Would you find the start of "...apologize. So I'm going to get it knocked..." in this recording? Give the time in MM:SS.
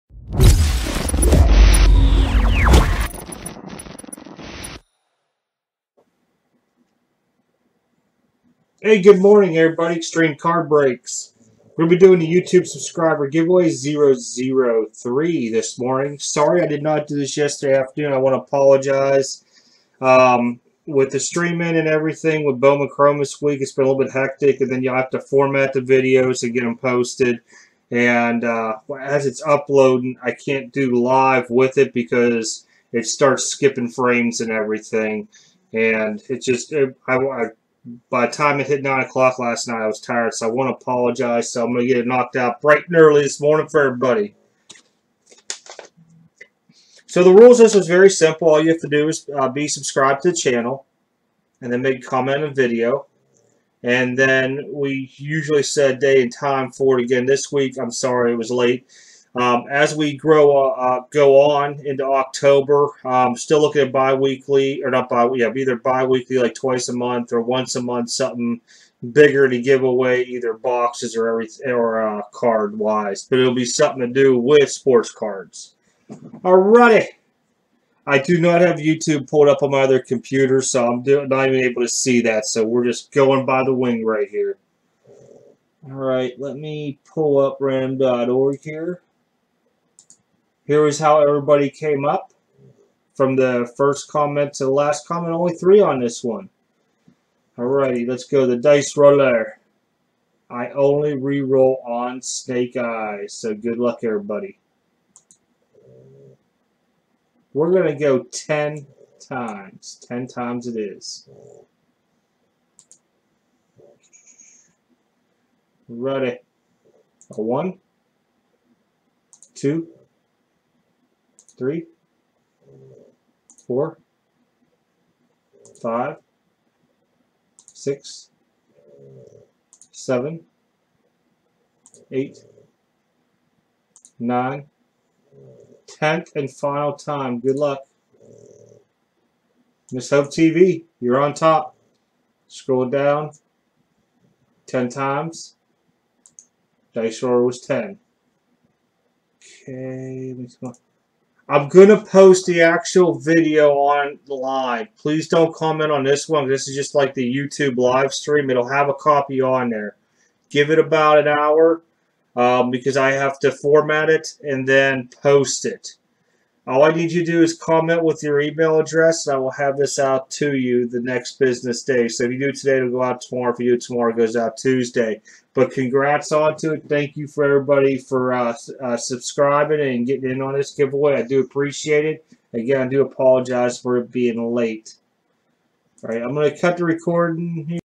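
00:40.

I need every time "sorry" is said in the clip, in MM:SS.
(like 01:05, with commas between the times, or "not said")
00:16, 00:57.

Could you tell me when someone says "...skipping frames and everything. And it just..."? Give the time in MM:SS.
00:33.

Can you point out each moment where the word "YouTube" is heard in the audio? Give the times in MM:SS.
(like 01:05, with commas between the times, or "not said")
00:12, 01:18, 02:37.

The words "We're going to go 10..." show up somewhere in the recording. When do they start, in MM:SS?
01:47.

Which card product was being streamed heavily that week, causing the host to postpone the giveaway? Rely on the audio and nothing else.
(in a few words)
Bowman Chrome.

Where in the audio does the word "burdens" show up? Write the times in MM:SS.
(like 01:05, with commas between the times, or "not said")
not said.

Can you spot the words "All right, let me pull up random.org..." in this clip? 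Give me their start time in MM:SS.
01:25.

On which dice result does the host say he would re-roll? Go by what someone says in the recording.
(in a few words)
Snake Eyes.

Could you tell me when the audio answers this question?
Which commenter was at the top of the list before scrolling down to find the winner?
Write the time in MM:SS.
02:19.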